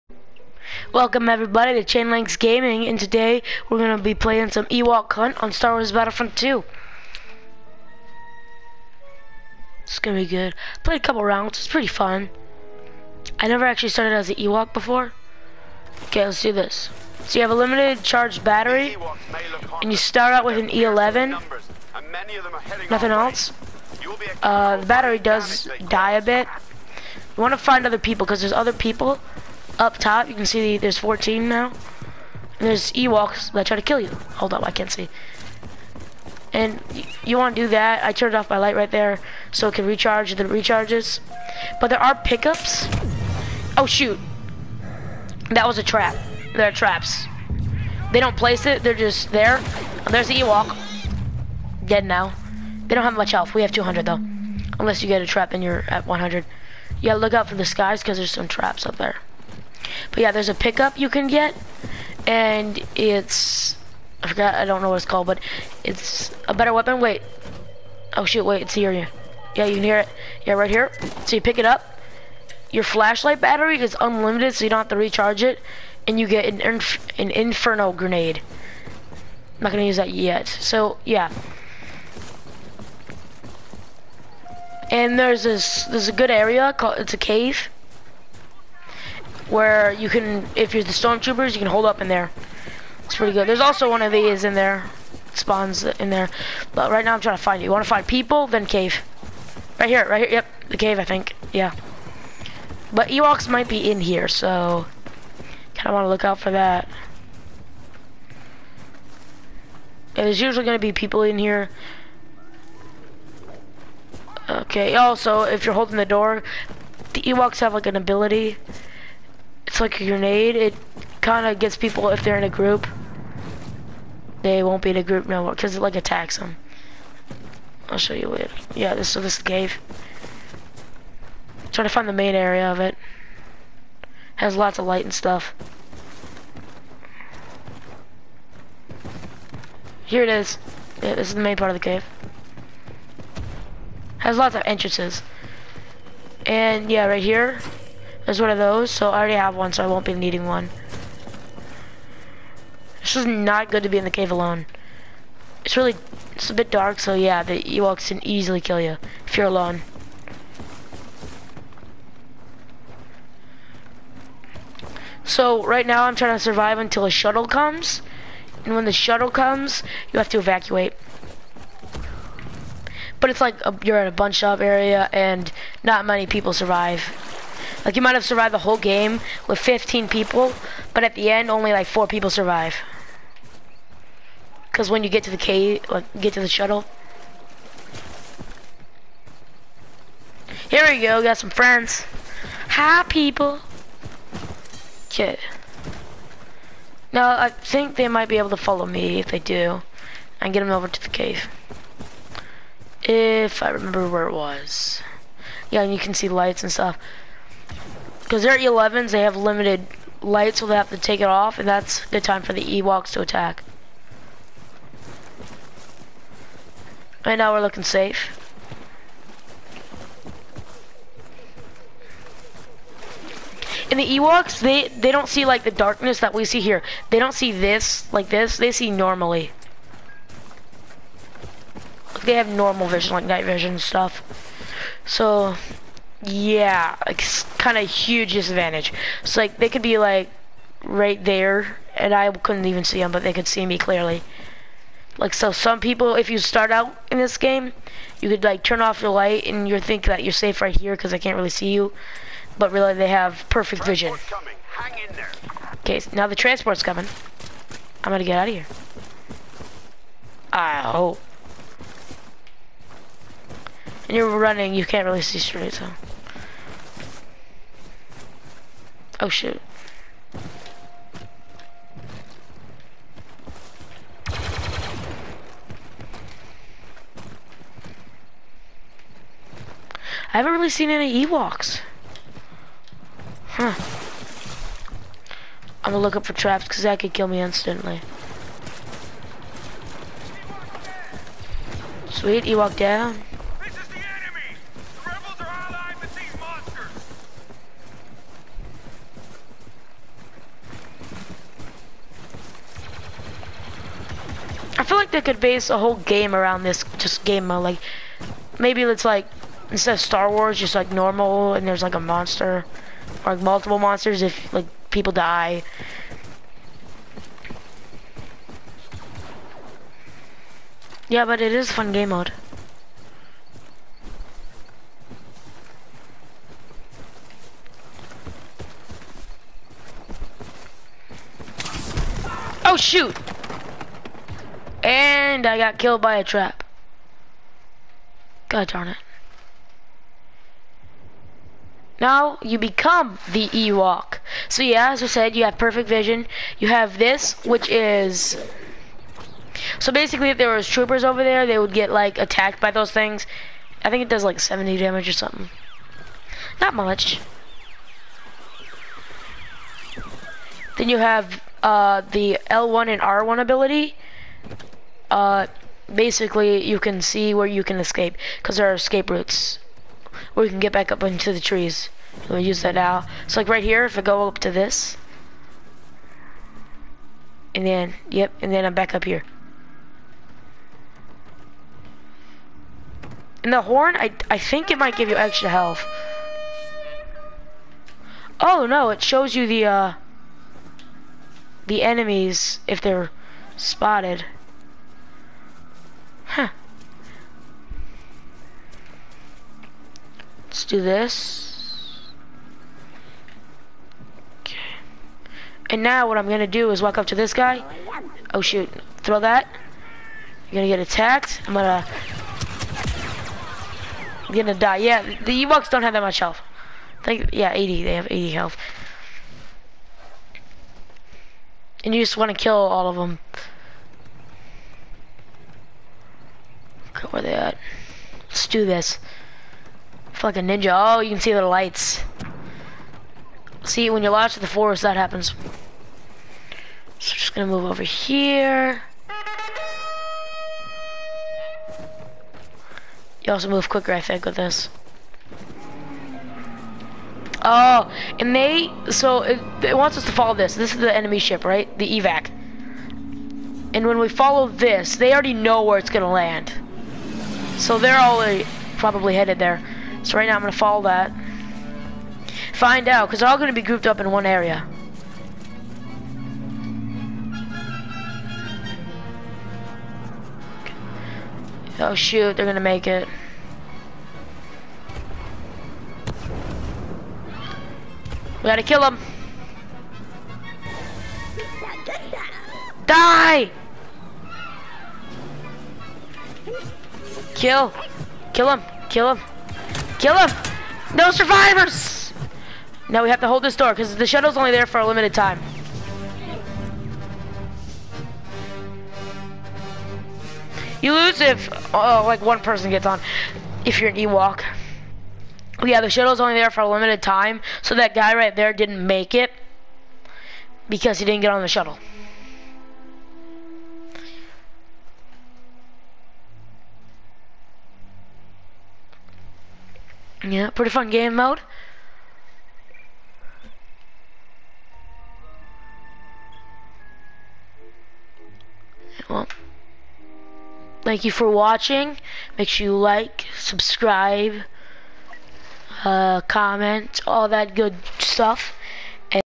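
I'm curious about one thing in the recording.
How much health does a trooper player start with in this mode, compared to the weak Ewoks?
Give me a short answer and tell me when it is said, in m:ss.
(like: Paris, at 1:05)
200, at 0:53.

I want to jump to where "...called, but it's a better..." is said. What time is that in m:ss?
1:05.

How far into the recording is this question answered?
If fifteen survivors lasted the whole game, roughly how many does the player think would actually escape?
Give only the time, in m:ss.
3:01.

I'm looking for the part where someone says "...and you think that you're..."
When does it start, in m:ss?
4:09.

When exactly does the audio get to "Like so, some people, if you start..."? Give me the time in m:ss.
4:05.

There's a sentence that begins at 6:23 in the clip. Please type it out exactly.
And the horn, I, I think it might give you extra health.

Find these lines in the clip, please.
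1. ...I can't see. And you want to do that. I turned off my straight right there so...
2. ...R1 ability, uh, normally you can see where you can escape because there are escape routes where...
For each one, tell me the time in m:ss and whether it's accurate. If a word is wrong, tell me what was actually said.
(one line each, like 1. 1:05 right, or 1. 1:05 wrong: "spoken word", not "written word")
1. 0:34 wrong: "light", not "straight"
2. 6:03 wrong: "basically", not "normally".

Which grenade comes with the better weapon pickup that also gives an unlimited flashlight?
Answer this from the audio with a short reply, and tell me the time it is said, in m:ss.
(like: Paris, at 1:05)
inferno grenade, at 1:17.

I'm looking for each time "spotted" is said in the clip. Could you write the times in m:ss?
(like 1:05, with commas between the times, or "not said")
6:33.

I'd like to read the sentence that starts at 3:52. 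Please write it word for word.
They have normal vision, like night vision and stuff.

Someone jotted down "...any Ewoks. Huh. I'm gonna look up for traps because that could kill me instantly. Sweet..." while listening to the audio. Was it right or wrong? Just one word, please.
right.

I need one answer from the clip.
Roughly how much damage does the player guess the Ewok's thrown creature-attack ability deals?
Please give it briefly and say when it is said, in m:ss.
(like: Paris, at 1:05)
70, at 5:54.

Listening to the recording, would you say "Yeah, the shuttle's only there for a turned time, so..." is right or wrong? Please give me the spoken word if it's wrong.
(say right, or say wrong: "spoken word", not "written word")
wrong: "limited", not "turned".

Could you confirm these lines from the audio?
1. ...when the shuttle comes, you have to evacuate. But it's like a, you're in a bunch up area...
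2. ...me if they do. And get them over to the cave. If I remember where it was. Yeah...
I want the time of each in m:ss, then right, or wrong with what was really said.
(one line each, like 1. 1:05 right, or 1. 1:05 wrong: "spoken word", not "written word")
1. 2:48 right
2. 3:18 right.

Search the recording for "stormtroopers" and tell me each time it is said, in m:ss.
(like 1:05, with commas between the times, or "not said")
1:30.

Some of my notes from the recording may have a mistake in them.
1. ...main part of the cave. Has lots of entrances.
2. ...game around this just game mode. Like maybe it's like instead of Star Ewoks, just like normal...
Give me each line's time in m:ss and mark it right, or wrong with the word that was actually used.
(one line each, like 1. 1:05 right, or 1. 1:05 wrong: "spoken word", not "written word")
1. 2:21 right
2. 5:05 wrong: "Wars", not "Ewoks".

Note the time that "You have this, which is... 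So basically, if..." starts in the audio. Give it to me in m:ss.
5:46.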